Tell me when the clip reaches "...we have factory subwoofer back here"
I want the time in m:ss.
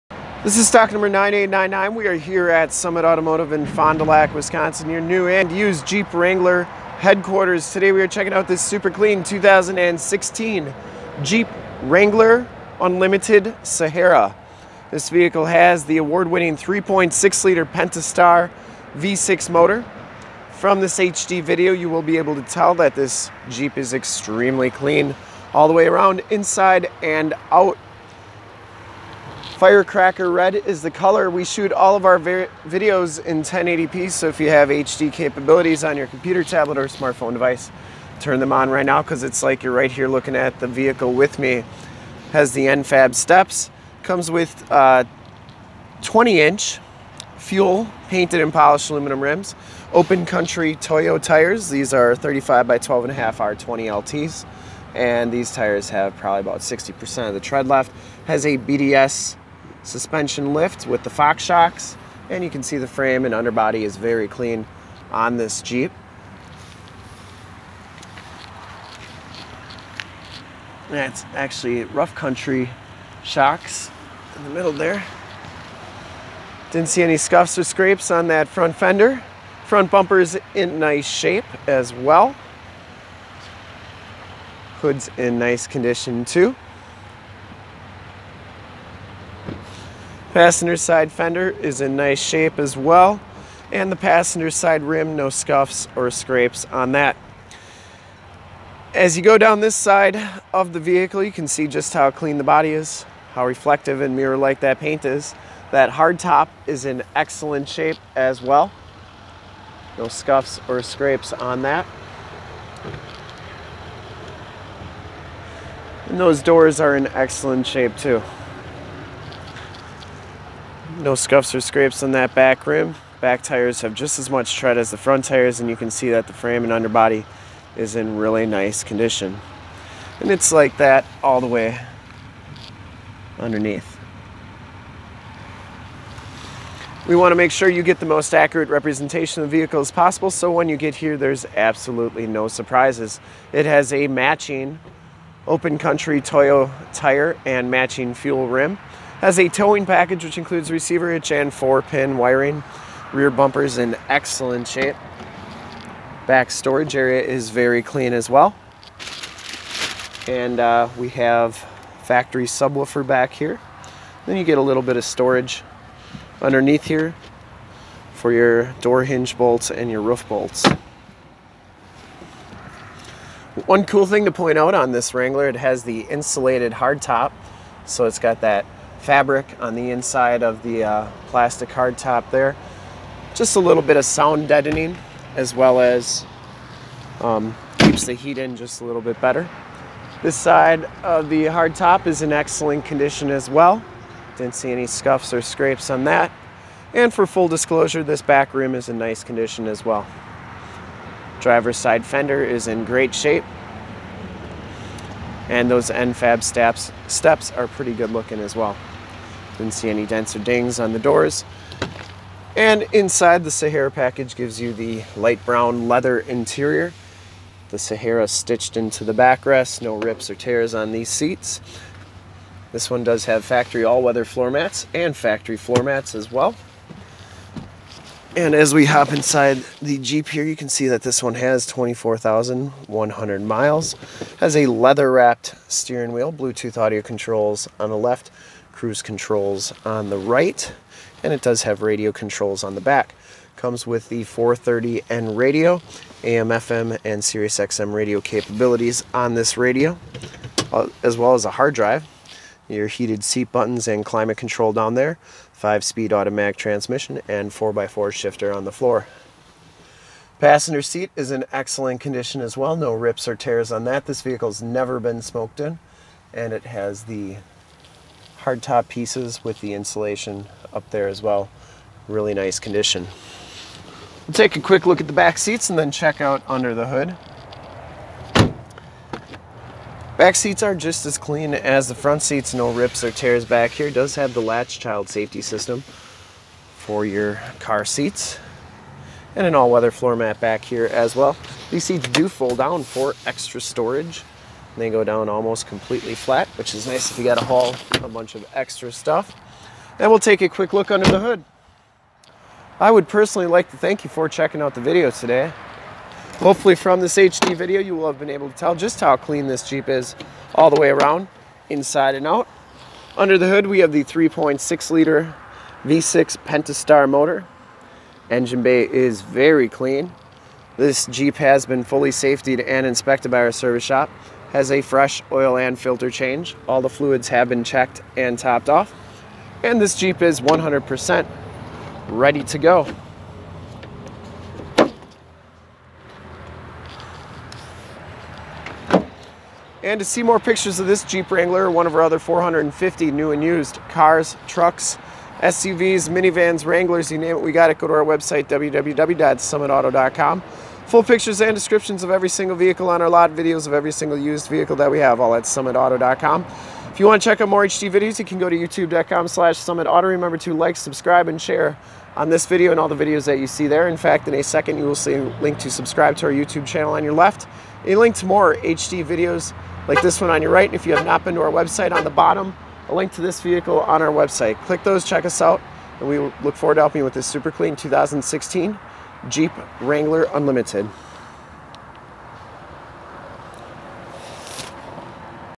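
2:40.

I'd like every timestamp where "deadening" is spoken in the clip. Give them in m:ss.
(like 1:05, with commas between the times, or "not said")
3:04.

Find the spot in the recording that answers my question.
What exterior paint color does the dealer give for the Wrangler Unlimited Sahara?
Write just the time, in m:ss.
0:29.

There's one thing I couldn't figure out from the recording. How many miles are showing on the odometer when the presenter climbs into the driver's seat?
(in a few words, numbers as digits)
24,100.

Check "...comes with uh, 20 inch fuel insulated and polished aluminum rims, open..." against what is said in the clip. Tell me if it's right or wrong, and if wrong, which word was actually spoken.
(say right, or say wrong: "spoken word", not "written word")
wrong: "painted", not "insulated".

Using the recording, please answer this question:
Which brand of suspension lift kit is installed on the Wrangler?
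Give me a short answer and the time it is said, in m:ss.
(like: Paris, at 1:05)
BDS, at 0:58.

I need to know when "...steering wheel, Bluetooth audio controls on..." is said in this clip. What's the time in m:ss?
3:55.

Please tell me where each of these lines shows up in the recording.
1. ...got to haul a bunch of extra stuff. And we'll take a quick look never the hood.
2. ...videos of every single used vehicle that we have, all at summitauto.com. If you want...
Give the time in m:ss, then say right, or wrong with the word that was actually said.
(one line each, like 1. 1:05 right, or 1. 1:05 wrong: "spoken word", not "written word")
1. 4:57 wrong: "under", not "never"
2. 5:53 right.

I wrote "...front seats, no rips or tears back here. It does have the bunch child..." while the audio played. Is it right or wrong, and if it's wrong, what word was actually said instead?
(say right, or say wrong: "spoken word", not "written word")
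wrong: "latch", not "bunch".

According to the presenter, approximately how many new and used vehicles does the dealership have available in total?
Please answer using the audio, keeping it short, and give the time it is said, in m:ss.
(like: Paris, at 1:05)
450, at 5:42.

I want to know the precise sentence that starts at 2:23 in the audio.
It has a matching open country Toyo tire and matching fuel rim.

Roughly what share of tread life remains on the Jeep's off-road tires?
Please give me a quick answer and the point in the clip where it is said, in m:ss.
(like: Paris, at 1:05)
60%, at 0:56.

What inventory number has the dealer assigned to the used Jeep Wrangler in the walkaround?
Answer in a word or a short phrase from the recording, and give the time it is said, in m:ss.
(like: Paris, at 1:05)
9899, at 0:00.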